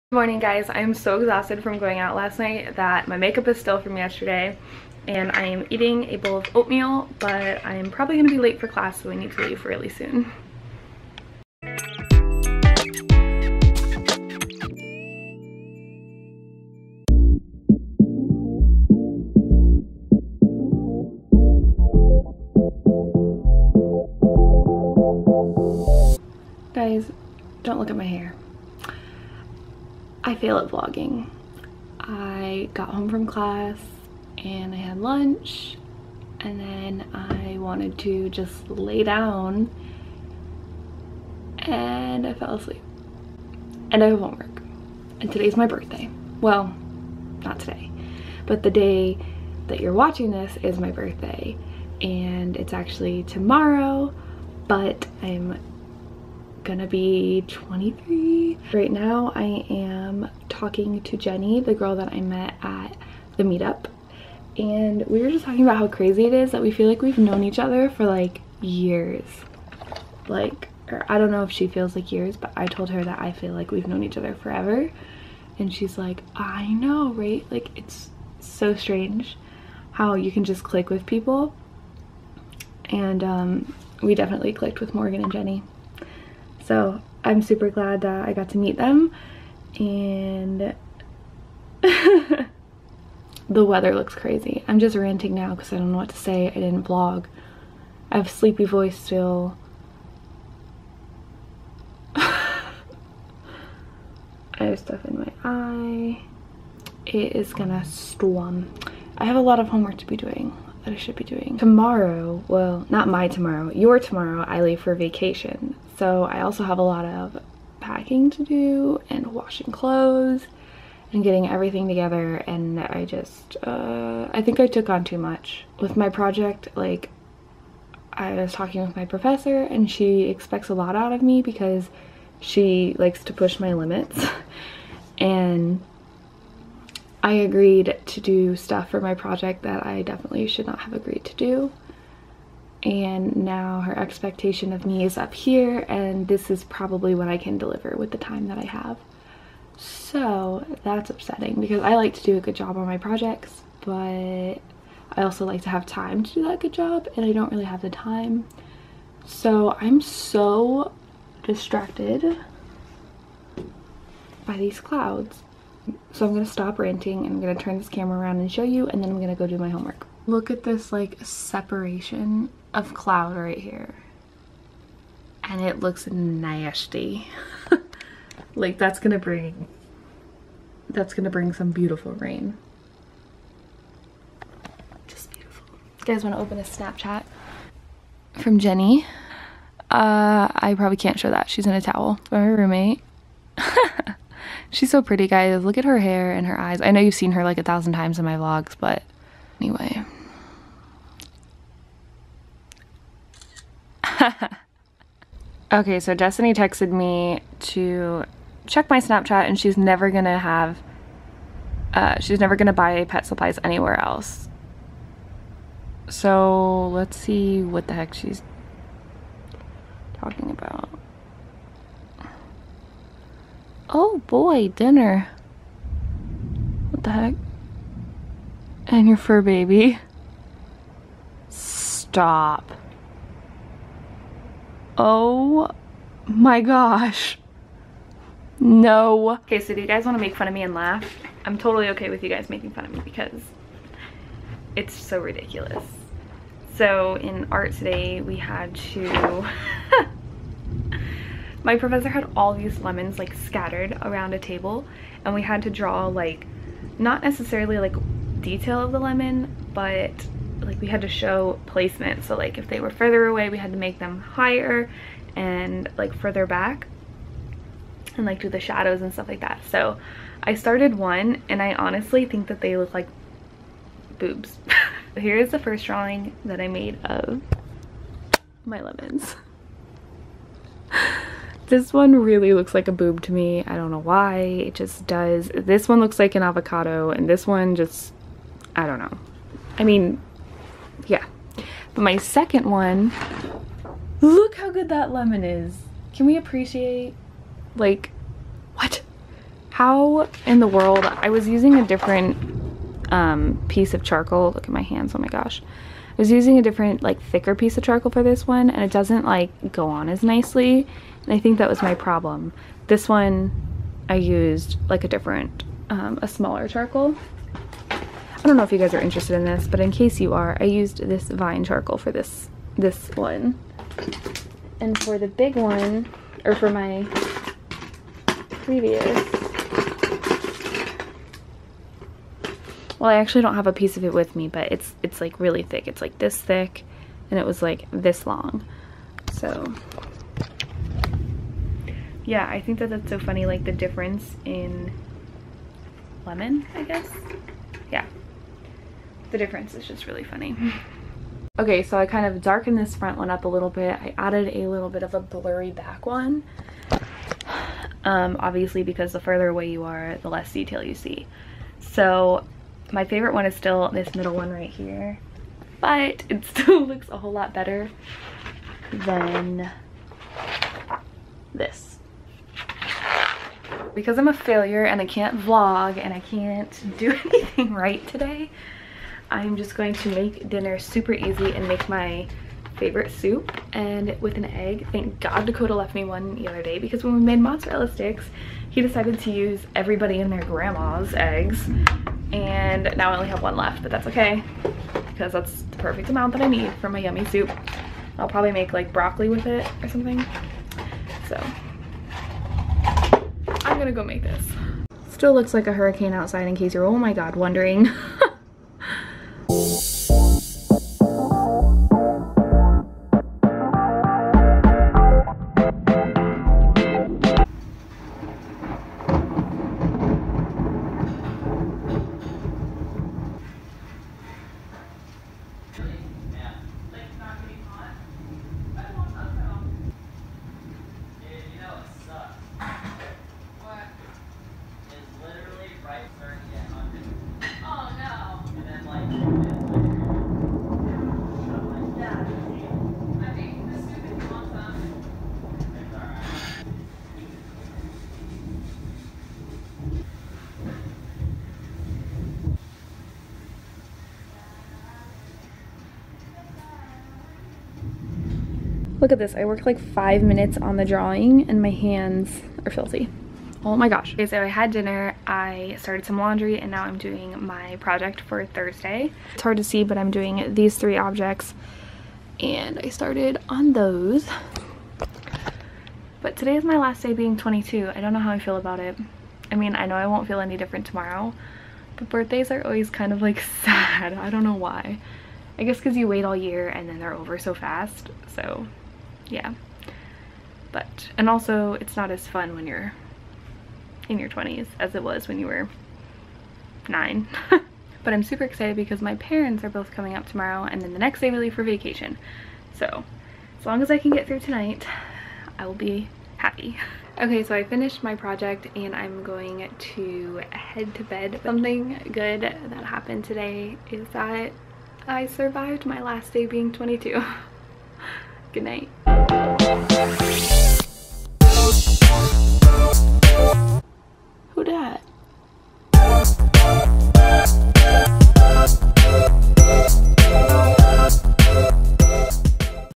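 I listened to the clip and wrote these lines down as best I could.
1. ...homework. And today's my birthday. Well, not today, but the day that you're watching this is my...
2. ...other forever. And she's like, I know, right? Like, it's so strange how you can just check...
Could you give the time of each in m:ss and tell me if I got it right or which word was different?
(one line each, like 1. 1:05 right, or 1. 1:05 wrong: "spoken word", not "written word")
1. 0:44 right
2. 1:14 wrong: "click", not "check".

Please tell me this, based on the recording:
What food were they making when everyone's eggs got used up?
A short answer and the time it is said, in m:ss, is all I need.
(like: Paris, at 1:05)
Mozzarella sticks, at 6:27.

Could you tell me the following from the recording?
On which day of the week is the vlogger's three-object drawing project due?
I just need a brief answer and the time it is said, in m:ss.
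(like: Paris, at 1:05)
Thursday, at 7:48.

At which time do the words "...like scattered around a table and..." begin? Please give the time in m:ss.
4:13.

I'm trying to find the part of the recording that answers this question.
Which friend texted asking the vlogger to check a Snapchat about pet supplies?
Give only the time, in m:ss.
3:26.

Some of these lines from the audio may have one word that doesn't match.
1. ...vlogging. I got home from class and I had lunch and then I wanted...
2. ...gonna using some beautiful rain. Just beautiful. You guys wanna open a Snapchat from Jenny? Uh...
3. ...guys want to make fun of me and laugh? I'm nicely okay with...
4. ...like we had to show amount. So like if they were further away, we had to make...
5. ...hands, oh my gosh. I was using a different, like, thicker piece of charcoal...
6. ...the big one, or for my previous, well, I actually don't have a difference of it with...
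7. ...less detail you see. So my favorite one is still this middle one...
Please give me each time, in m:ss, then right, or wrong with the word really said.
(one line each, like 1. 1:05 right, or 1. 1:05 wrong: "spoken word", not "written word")
1. 0:30 right
2. 3:01 wrong: "bring", not "using"
3. 3:59 wrong: "totally", not "nicely"
4. 4:20 wrong: "placement", not "amount"
5. 5:04 right
6. 5:25 wrong: "piece", not "difference"
7. 6:00 right.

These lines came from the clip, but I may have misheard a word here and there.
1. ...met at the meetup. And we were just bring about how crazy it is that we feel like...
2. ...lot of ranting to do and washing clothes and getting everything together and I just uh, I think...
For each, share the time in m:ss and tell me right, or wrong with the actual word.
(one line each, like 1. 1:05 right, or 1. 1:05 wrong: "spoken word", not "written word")
1. 1:02 wrong: "talking", not "bring"
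2. 1:56 wrong: "packing", not "ranting".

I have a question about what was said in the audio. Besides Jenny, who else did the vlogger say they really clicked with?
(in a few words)
Morgan.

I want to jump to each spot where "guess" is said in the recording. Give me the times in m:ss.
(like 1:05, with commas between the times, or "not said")
5:46, 8:05.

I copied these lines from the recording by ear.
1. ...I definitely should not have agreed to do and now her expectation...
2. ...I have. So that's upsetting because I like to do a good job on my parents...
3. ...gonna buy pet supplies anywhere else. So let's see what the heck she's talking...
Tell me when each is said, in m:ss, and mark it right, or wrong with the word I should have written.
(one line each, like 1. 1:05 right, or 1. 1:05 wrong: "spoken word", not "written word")
1. 2:19 right
2. 2:28 wrong: "projects", not "parents"
3. 3:32 right.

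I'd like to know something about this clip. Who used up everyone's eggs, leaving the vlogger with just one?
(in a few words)
Dakota.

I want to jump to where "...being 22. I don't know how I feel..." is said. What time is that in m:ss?
7:57.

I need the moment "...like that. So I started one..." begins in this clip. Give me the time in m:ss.
4:29.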